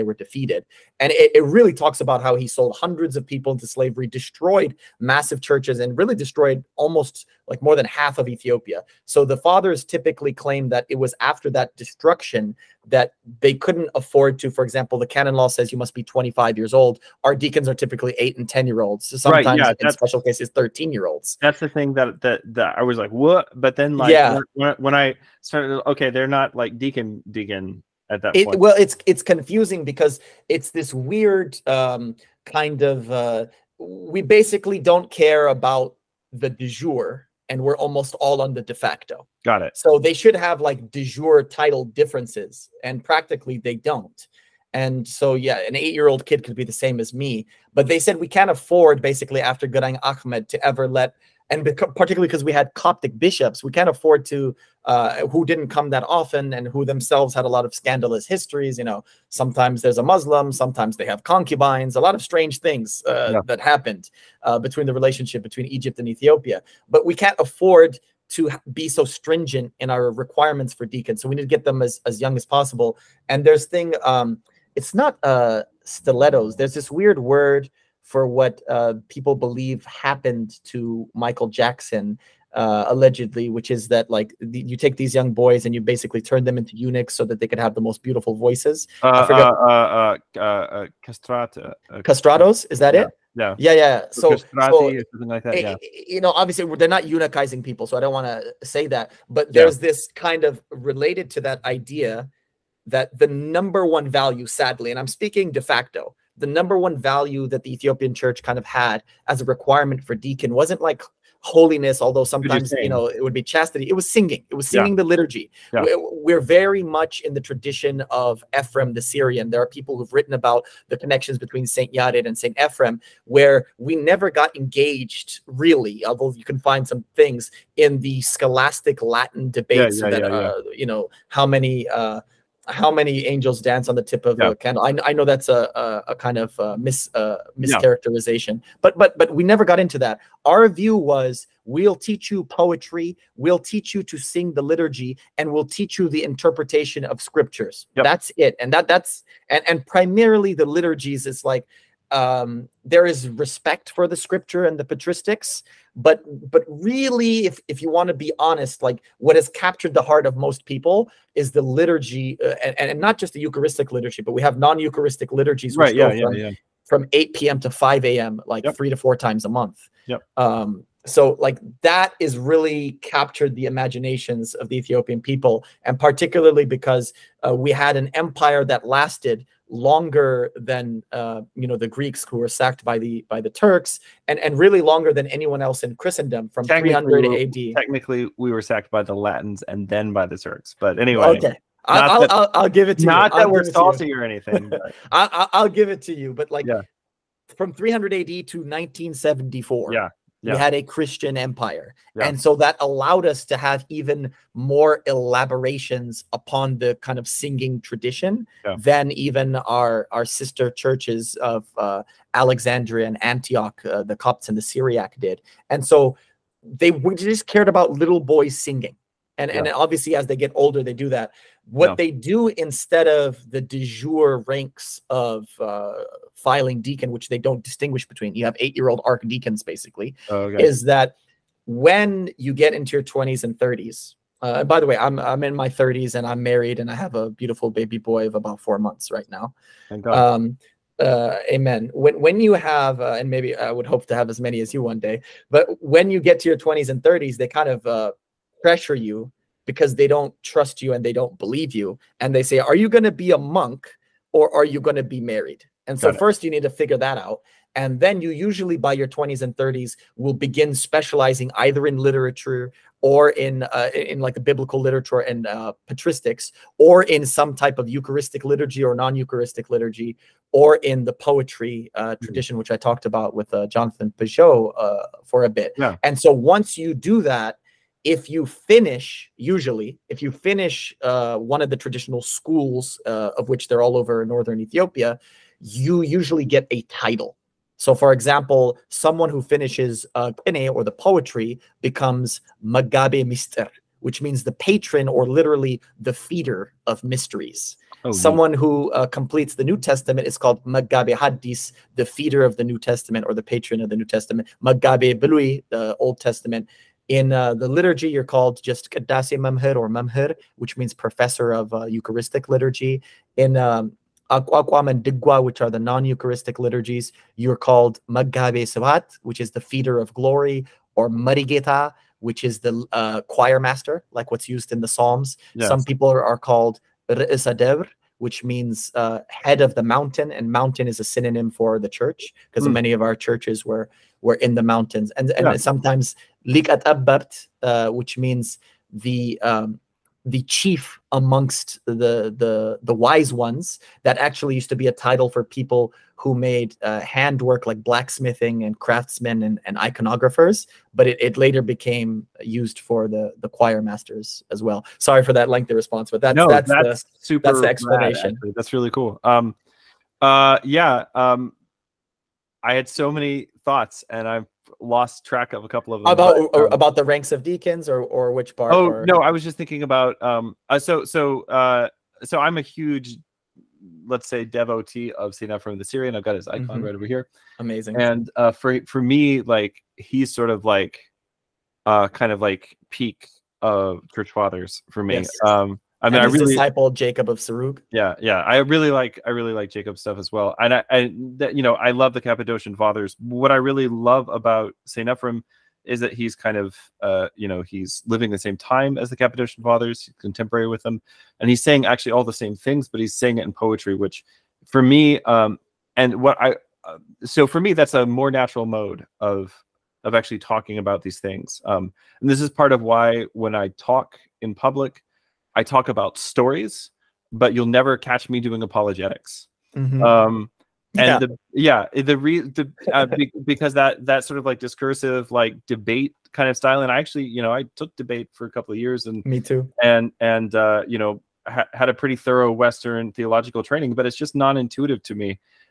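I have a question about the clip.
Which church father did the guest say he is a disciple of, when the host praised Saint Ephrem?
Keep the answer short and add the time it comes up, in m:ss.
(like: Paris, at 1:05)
Jacob of Sarug, at 6:26.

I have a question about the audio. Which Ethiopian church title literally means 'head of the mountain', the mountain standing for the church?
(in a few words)
Re'esadevr.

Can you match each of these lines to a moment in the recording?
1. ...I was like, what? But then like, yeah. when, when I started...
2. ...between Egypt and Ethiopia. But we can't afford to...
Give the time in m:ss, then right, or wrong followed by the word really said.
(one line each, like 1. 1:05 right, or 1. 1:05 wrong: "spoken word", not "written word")
1. 0:22 right
2. 1:05 right.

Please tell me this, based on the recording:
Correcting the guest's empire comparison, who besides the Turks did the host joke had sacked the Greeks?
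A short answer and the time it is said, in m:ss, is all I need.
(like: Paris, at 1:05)
The Latins, at 3:09.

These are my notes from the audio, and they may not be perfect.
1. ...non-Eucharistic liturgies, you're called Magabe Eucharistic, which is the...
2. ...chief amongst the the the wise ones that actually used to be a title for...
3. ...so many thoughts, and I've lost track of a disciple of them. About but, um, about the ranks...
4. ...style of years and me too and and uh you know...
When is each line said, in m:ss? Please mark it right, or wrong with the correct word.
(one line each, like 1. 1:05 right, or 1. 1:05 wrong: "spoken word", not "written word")
1. 5:15 wrong: "Sabat", not "Eucharistic"
2. 5:40 right
3. 6:02 wrong: "couple", not "disciple"
4. 7:08 wrong: "couple", not "style".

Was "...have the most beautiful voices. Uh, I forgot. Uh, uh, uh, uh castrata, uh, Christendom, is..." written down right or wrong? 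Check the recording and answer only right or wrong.
wrong.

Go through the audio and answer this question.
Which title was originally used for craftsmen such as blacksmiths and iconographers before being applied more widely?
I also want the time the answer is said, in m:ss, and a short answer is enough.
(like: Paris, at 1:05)
Lik, at 5:36.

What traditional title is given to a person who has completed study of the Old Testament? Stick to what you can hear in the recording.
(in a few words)
Magabe Belui.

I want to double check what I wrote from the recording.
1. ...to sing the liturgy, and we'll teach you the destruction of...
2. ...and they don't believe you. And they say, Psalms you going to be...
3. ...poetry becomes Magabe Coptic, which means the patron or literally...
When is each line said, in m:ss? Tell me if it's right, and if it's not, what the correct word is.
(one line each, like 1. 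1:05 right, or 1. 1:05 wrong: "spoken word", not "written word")
1. 2:24 wrong: "interpretation", not "destruction"
2. 4:10 wrong: "Are", not "Psalms"
3. 4:50 wrong: "Mister", not "Coptic".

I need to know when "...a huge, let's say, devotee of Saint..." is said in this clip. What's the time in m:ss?
6:12.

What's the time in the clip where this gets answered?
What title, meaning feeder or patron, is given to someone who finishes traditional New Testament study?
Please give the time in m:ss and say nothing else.
5:00.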